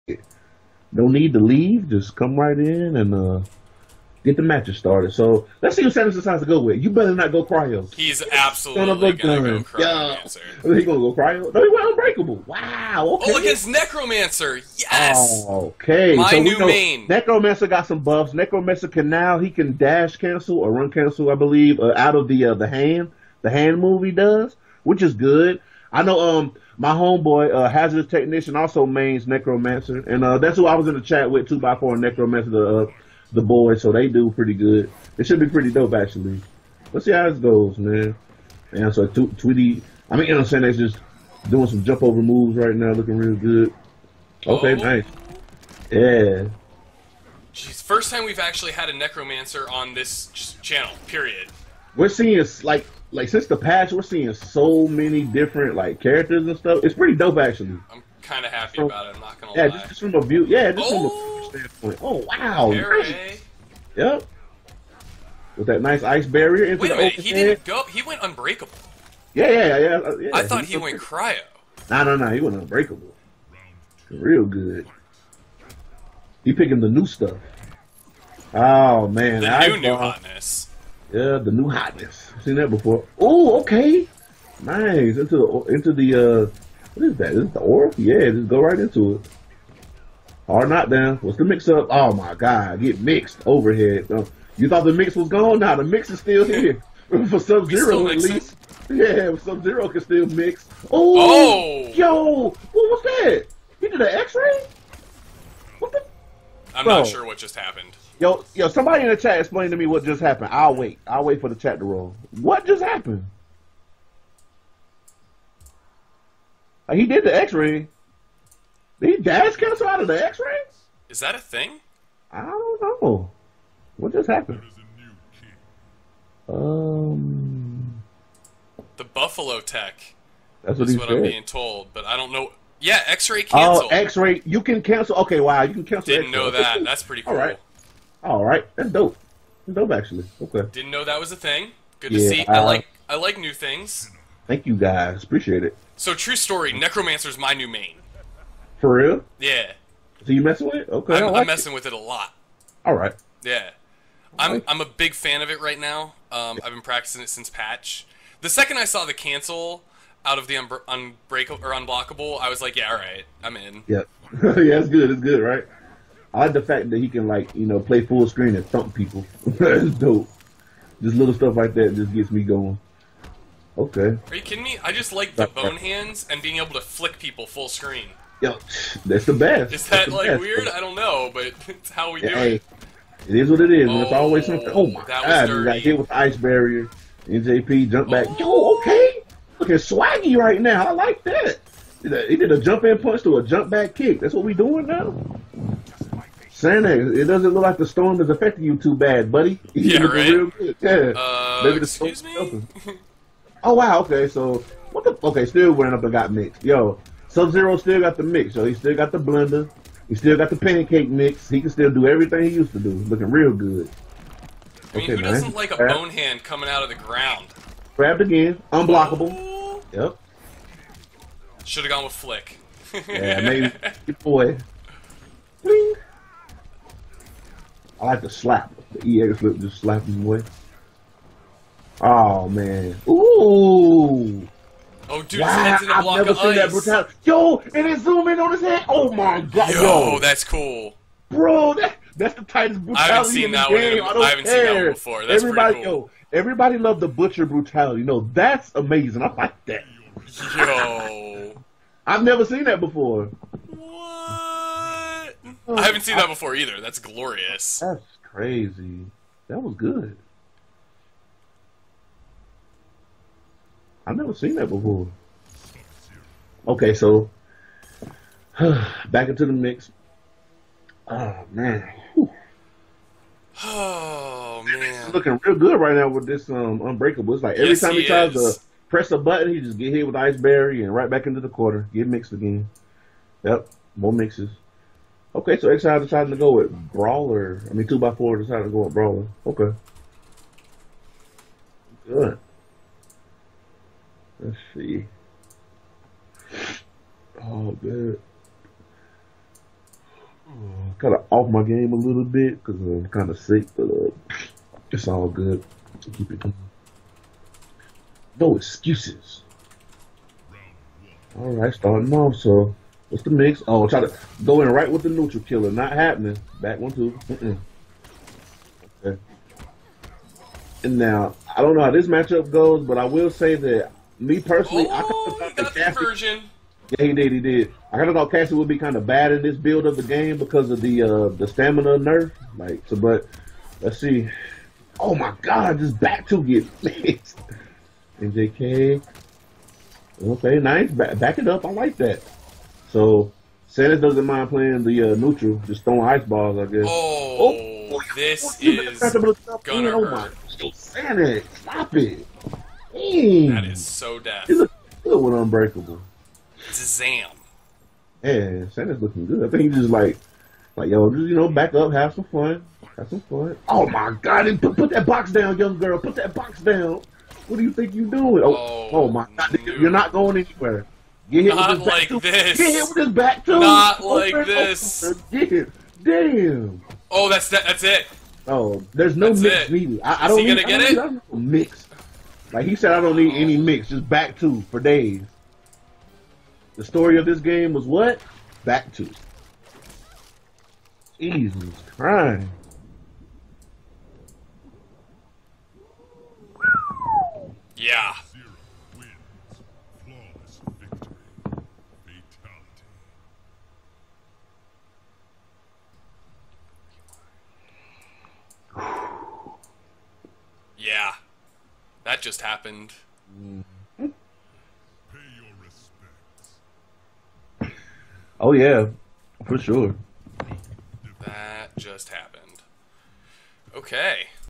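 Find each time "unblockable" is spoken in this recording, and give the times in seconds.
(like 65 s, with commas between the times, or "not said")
161 s, 218 s.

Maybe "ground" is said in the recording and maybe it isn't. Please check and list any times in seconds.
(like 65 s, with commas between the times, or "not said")
216 s.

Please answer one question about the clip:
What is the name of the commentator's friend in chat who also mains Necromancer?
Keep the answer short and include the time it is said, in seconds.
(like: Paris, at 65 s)
Hazardous technician, at 27 s.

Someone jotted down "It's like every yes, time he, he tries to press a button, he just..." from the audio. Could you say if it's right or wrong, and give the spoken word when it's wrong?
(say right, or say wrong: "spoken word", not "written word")
right.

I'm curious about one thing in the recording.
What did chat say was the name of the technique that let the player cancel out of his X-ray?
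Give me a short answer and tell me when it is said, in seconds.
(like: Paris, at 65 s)
The Buffalo Tech, at 128 s.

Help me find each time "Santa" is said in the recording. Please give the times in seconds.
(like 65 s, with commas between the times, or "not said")
343 s, 350 s, 358 s.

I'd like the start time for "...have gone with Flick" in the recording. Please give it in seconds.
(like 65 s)
221 s.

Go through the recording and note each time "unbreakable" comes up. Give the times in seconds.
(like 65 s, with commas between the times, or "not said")
11 s, 68 s, 72 s, 160 s, 276 s, 355 s.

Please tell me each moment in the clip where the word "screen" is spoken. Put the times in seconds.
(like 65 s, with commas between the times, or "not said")
168 s, 177 s.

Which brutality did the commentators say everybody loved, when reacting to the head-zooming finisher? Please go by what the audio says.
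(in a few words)
Butcher brutality.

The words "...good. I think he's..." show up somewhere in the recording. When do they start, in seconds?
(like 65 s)
359 s.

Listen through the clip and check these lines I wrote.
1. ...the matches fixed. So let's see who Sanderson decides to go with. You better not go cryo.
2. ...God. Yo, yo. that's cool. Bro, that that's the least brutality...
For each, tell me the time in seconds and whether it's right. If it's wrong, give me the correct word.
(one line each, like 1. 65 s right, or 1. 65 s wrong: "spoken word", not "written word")
1. 4 s wrong: "started", not "fixed"
2. 239 s wrong: "tightest", not "least".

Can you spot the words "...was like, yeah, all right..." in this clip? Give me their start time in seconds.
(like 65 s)
162 s.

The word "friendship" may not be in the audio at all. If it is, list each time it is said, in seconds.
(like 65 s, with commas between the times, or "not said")
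not said.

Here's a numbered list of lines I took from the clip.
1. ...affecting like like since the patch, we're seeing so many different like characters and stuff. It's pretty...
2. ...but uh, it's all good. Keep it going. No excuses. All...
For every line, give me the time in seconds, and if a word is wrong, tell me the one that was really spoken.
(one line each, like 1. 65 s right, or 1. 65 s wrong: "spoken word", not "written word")
1. 52 s wrong: "seeing", not "affecting"
2. 303 s right.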